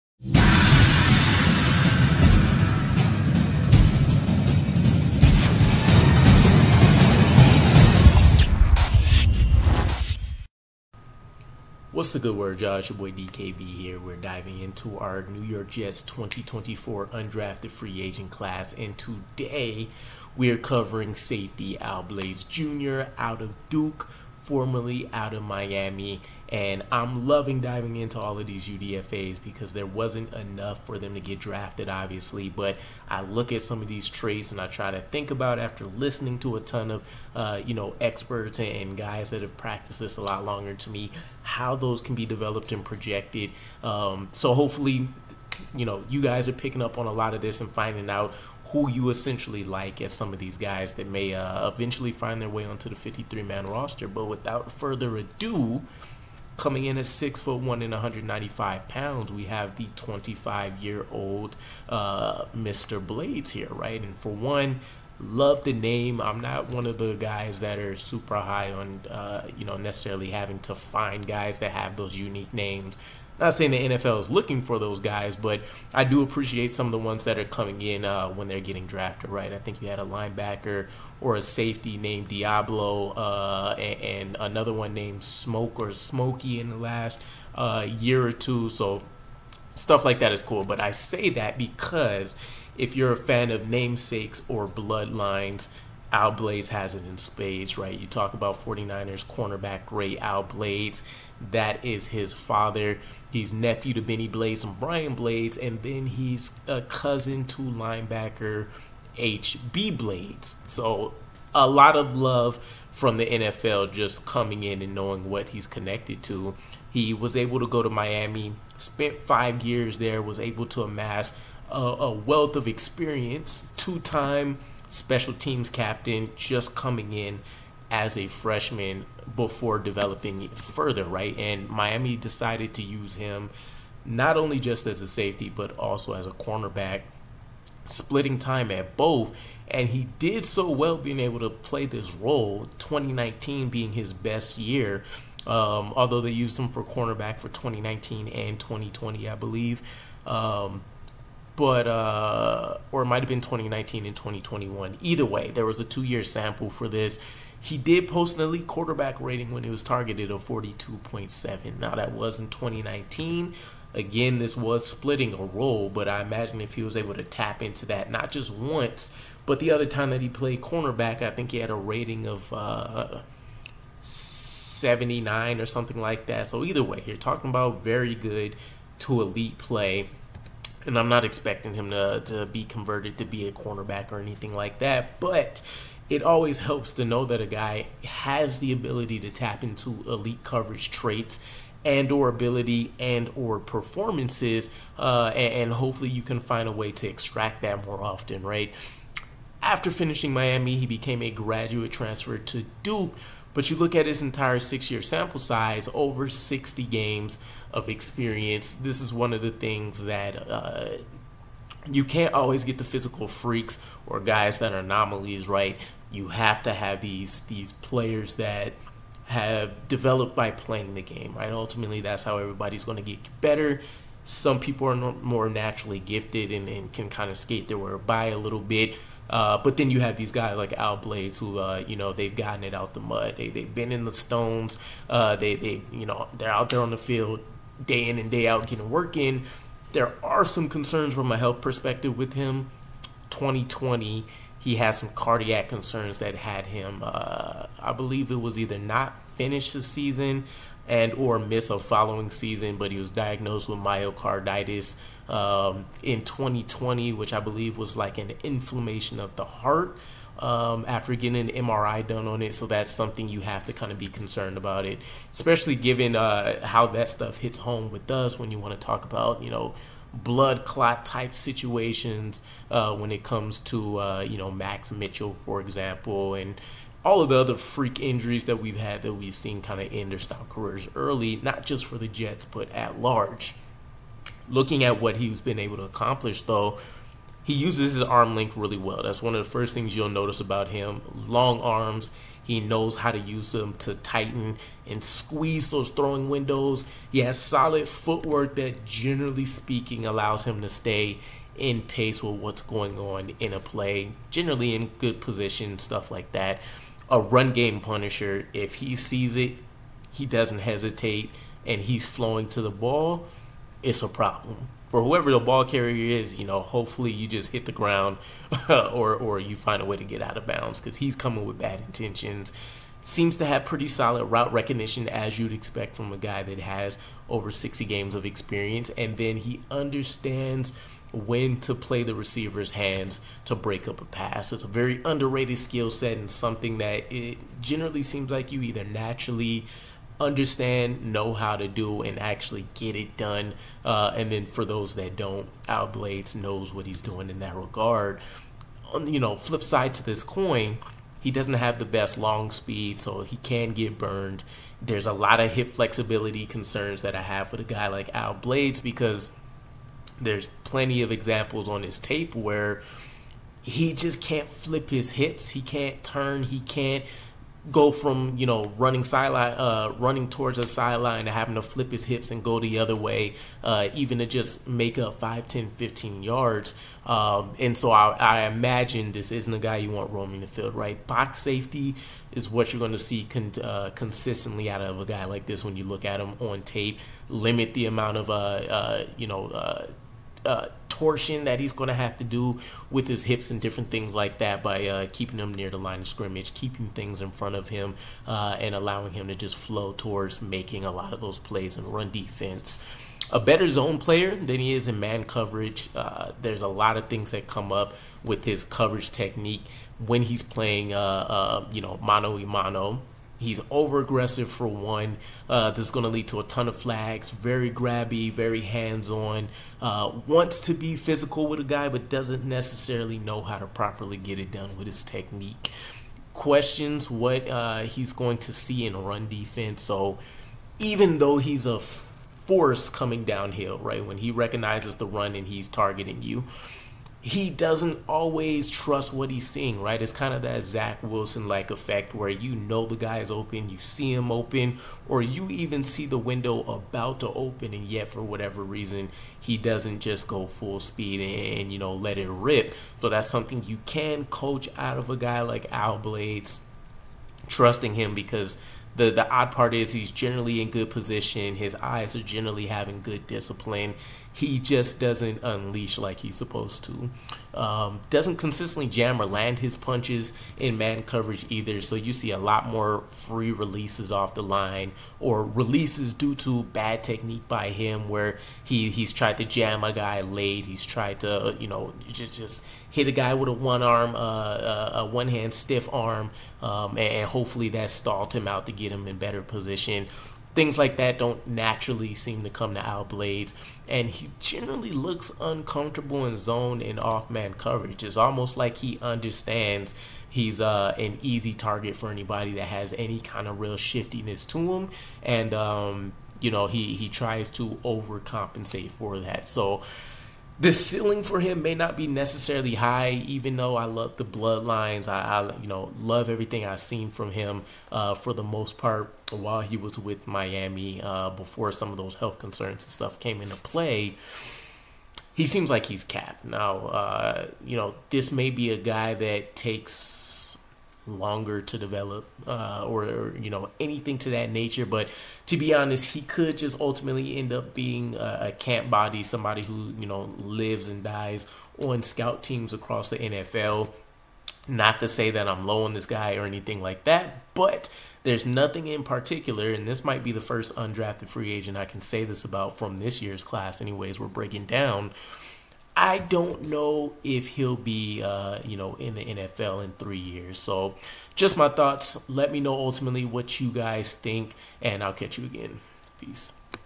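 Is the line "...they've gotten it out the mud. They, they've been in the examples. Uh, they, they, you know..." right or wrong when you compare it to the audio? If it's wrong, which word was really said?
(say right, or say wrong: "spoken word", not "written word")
wrong: "stones", not "examples".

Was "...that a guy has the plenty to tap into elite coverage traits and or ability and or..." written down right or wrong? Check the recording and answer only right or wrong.
wrong.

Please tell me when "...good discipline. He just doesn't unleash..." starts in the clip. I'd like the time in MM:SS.
07:43.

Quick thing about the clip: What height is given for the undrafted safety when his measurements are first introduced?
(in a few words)
6 foot 1.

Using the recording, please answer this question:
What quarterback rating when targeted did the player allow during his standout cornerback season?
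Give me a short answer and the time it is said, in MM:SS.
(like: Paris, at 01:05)
42.7, at 02:40.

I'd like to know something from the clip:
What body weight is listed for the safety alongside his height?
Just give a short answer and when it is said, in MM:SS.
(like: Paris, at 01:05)
195 pounds, at 00:57.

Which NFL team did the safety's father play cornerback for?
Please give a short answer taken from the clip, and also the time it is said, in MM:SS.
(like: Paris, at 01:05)
49ers, at 01:38.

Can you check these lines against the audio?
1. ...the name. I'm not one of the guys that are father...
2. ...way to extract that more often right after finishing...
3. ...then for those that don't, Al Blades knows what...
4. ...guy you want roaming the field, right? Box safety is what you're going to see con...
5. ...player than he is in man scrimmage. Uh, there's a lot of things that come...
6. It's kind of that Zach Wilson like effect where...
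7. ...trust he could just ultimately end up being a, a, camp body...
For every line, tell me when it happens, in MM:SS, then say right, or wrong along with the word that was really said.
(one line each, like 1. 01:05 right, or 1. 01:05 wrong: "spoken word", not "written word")
1. 01:05 wrong: "super", not "father"
2. 03:16 right
3. 05:44 right
4. 06:19 right
5. 06:43 wrong: "coverage", not "scrimmage"
6. 07:20 right
7. 08:55 wrong: "honest", not "trust".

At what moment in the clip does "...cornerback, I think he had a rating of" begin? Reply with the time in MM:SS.
02:50.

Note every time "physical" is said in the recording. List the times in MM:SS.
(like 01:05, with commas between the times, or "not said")
03:32, 07:00.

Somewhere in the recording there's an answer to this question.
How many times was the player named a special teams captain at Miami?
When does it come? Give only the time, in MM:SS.
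02:03.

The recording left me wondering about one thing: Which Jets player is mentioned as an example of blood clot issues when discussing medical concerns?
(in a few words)
Max Mitchell.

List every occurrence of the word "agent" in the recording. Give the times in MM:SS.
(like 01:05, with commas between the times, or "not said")
00:18, 09:11.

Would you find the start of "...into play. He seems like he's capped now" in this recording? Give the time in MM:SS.
08:43.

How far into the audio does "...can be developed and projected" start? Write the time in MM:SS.
00:42.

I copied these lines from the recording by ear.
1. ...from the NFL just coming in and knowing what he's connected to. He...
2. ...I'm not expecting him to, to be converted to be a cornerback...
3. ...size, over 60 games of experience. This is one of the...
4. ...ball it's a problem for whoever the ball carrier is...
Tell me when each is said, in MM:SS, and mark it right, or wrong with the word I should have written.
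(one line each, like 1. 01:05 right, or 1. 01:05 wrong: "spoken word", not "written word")
1. 01:52 right
2. 03:00 right
3. 03:25 right
4. 05:12 right.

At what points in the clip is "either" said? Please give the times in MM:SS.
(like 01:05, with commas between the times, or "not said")
02:34, 02:56, 04:08, 05:38, 07:51.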